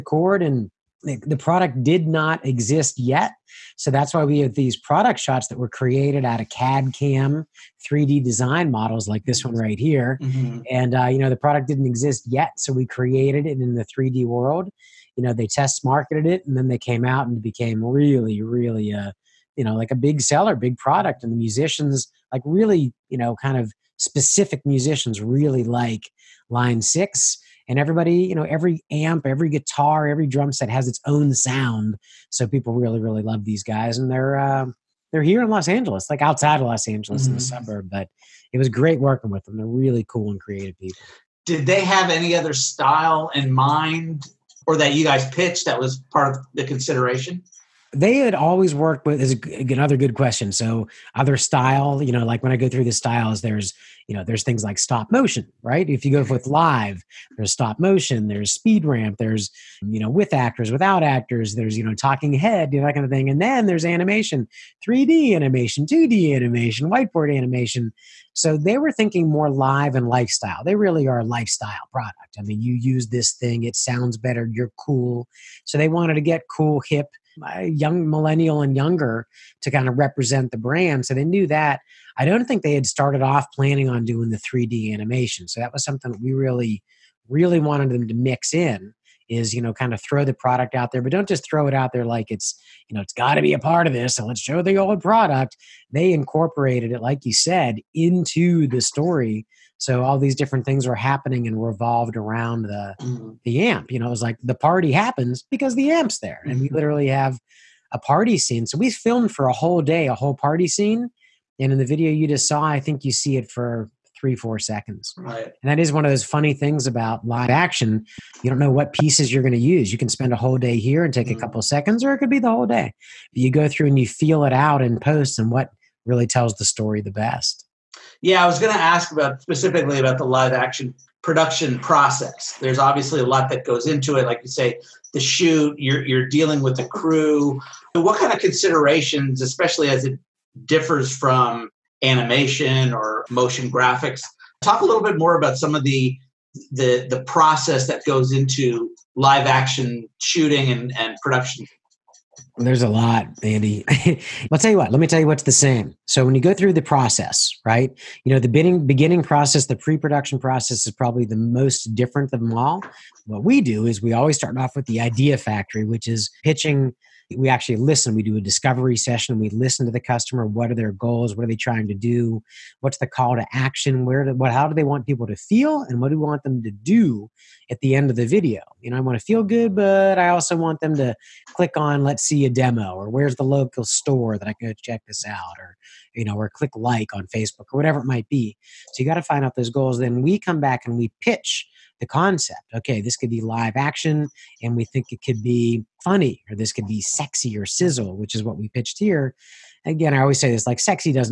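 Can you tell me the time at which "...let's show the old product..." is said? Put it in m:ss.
1:34.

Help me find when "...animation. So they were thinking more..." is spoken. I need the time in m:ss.
1:07.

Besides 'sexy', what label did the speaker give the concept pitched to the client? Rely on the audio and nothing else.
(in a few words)
sizzle.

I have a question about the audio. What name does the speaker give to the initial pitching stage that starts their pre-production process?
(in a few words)
the idea factory.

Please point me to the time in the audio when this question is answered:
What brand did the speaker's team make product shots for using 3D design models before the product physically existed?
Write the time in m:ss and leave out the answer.
0:26.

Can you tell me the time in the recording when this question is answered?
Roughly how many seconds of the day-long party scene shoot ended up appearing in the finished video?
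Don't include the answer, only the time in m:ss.
1:54.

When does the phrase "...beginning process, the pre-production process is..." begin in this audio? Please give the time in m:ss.
2:38.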